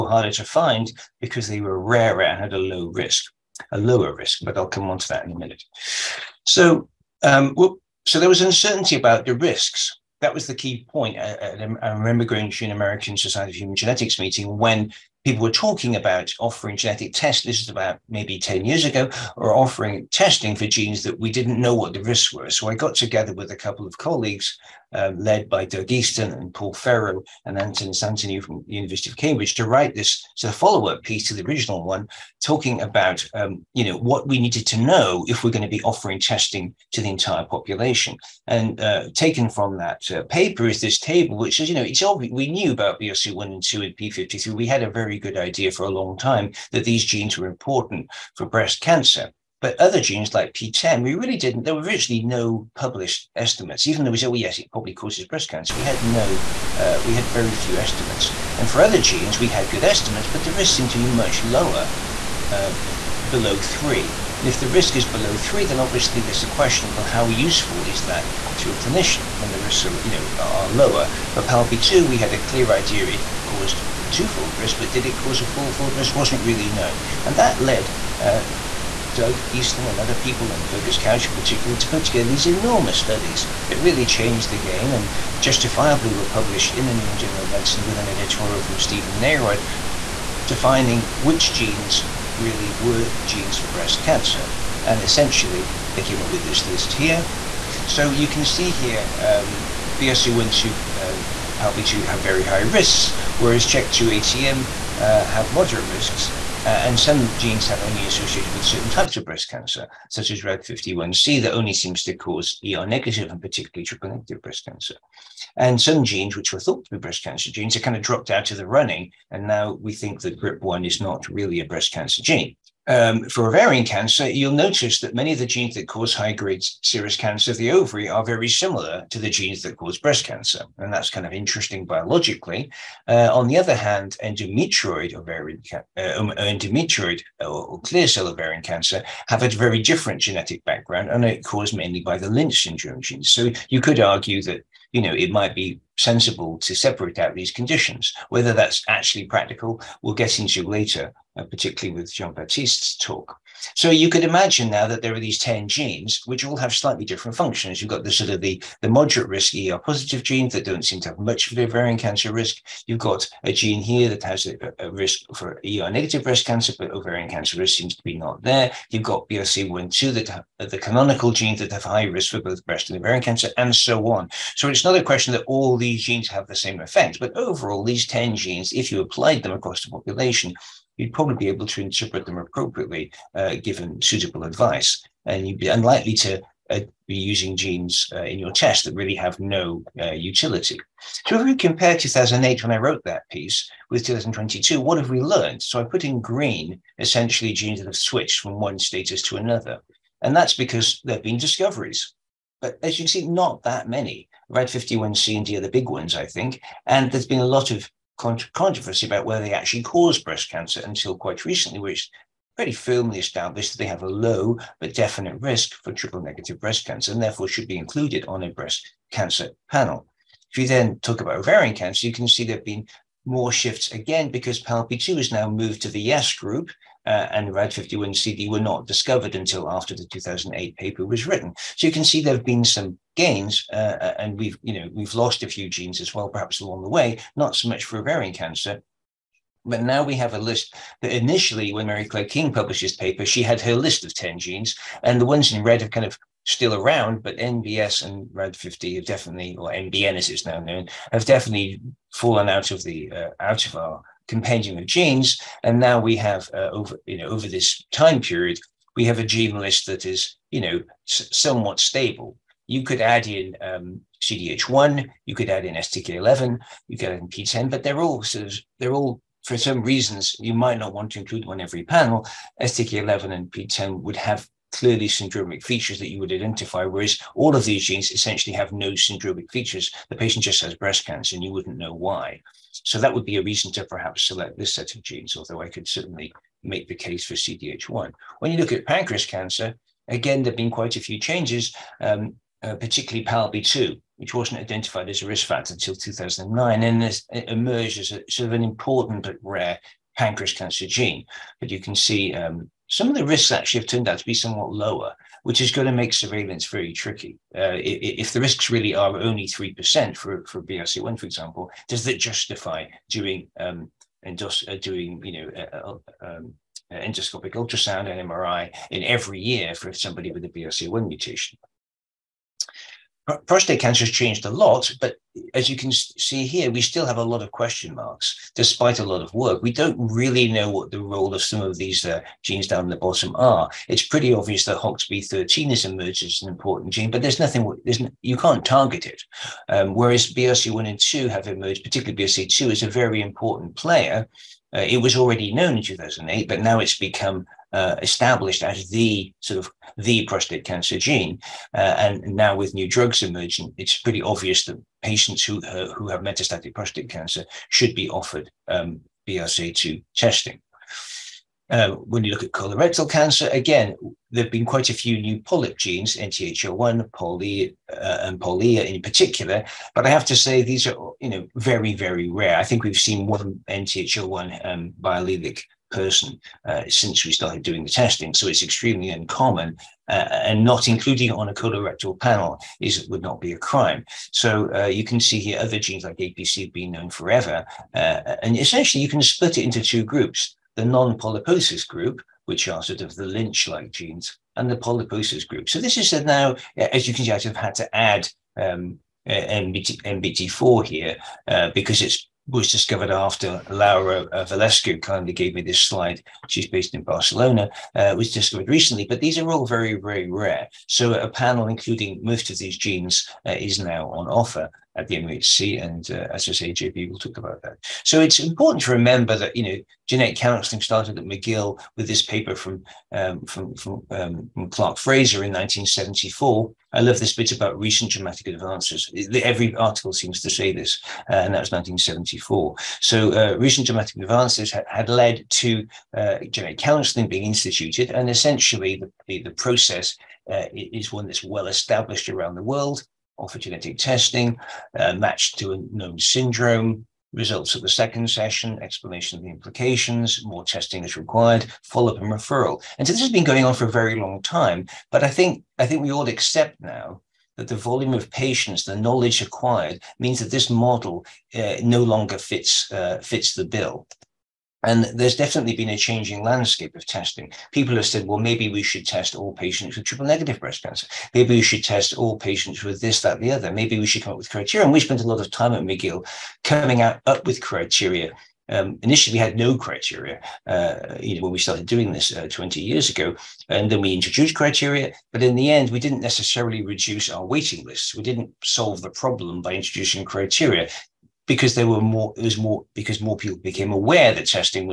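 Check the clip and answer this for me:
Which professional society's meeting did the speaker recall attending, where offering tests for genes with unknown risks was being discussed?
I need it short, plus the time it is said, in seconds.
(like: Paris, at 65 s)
American Society of Human Genetics, at 12 s.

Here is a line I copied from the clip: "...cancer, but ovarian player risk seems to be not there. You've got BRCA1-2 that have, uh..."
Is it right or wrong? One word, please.
wrong.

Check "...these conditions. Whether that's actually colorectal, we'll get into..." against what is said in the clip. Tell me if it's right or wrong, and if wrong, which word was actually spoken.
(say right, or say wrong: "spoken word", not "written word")
wrong: "practical", not "colorectal".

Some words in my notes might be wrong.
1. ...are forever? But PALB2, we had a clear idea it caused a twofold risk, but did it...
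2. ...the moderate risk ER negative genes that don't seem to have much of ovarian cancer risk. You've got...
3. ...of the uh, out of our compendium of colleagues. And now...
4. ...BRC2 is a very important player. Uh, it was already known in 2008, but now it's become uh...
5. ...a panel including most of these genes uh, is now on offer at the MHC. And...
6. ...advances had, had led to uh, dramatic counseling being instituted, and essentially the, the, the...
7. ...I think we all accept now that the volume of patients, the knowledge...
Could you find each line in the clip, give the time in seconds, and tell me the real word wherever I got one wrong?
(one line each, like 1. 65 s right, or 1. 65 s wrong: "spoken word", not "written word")
1. 70 s wrong: "lower", not "forever"
2. 158 s wrong: "positive", not "negative"
3. 252 s wrong: "genes", not "colleagues"
4. 342 s right
5. 411 s right
6. 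434 s wrong: "genetic", not "dramatic"
7. 455 s right.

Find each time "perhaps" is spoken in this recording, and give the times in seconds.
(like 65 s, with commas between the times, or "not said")
236 s, 283 s.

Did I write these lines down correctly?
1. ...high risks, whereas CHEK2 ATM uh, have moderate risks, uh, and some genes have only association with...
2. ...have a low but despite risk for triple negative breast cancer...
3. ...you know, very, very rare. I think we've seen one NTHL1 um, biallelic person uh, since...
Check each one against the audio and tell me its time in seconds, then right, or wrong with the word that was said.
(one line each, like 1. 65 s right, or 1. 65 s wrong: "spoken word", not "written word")
1. 102 s right
2. 213 s wrong: "definite", not "despite"
3. 371 s right.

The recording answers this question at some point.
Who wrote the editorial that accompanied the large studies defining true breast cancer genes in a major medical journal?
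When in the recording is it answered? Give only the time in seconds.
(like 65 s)
88 s.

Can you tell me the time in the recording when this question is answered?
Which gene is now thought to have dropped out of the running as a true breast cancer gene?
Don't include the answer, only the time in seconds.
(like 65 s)
120 s.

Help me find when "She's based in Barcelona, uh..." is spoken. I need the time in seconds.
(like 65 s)
406 s.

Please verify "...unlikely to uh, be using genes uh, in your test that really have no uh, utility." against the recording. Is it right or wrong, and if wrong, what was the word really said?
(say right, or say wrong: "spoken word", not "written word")
right.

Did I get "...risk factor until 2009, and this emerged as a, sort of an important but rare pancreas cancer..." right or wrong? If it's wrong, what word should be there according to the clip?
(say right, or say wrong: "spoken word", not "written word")
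right.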